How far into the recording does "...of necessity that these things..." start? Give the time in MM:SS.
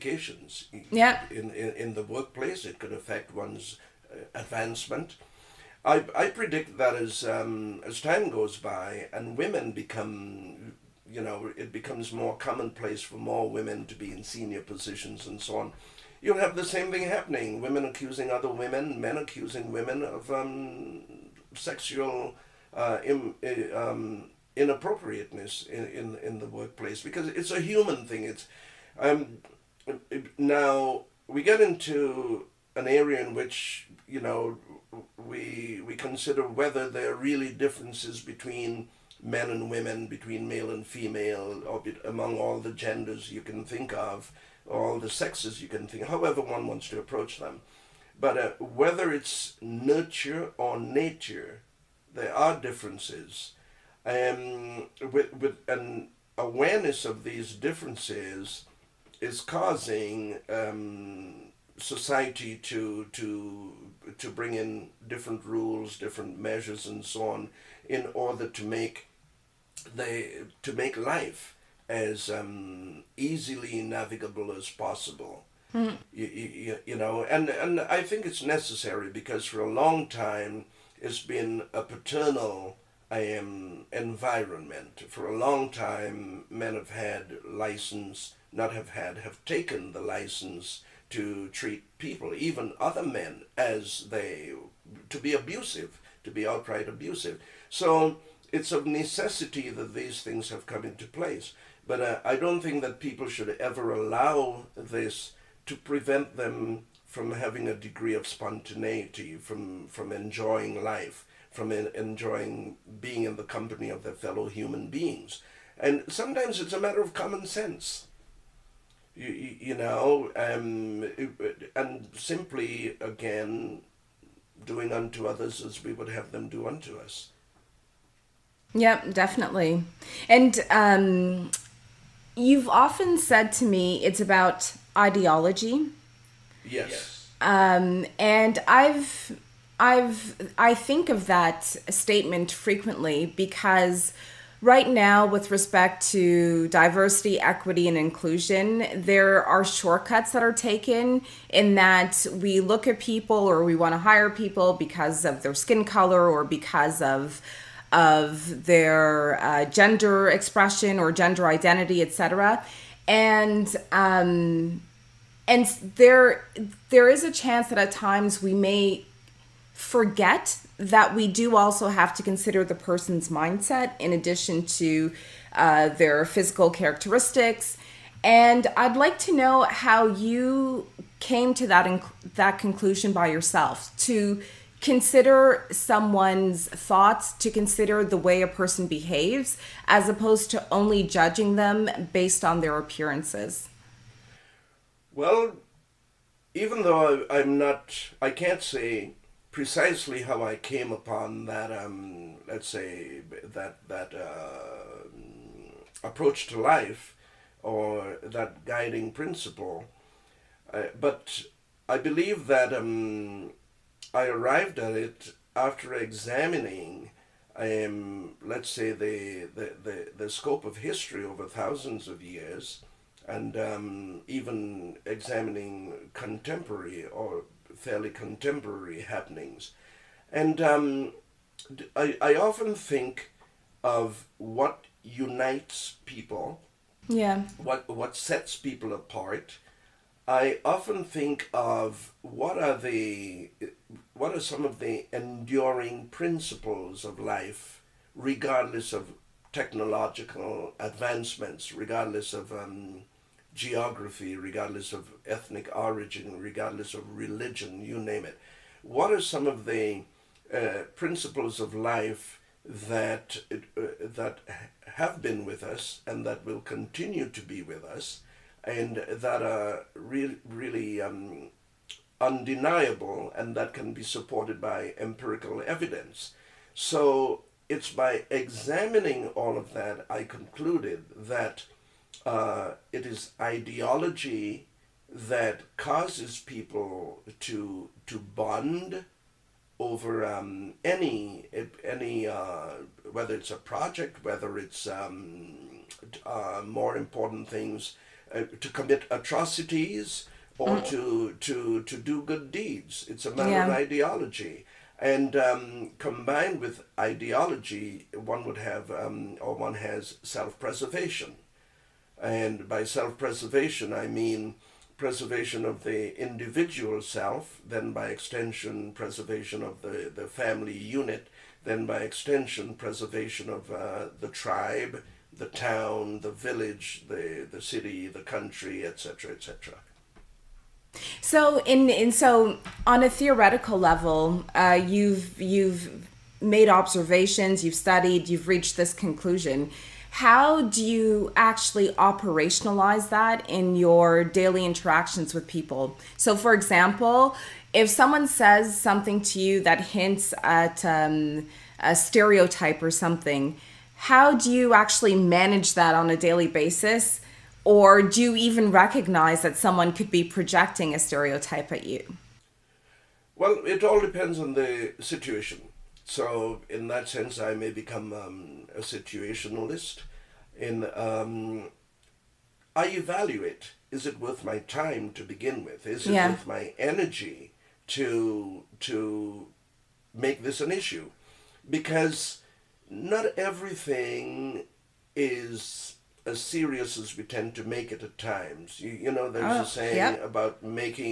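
01:38.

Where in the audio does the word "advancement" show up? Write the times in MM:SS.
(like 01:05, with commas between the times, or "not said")
00:04, 04:10.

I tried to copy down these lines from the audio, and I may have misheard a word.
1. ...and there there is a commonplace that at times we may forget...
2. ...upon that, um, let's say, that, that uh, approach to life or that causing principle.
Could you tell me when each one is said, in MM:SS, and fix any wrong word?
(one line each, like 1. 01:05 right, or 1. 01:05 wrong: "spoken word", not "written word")
1. 02:45 wrong: "chance", not "commonplace"
2. 03:20 wrong: "guiding", not "causing".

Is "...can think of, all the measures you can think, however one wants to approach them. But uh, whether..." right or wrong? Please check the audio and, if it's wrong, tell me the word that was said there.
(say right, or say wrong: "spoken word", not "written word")
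wrong: "sexes", not "measures".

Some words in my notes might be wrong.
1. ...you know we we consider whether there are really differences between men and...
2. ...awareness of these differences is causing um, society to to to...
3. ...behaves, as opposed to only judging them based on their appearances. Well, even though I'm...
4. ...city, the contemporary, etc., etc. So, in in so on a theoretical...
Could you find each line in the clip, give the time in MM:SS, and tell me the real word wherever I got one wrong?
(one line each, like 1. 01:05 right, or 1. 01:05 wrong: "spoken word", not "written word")
1. 00:34 right
2. 00:56 right
3. 03:08 right
4. 05:27 wrong: "country", not "contemporary".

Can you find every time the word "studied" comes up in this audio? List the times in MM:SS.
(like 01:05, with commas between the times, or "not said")
05:37.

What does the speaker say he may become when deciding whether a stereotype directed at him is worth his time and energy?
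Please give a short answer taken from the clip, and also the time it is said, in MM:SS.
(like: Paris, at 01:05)
a situationalist, at 06:08.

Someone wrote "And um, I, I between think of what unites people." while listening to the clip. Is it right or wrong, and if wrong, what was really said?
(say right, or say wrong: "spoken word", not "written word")
wrong: "often", not "between".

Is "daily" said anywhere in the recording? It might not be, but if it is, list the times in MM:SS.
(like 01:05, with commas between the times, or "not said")
05:44, 05:56.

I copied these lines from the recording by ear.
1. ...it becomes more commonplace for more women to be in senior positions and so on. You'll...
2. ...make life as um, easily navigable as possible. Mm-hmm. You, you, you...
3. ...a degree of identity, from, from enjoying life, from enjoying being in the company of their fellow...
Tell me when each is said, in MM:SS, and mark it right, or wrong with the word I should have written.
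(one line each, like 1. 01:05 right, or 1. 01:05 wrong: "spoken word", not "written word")
1. 00:11 right
2. 01:10 right
3. 01:47 wrong: "spontaneity", not "identity".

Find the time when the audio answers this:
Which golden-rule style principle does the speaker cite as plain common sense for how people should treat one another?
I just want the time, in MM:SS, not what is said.
02:04.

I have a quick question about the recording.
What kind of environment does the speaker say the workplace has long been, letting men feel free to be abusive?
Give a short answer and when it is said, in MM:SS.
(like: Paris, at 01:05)
paternal, at 01:21.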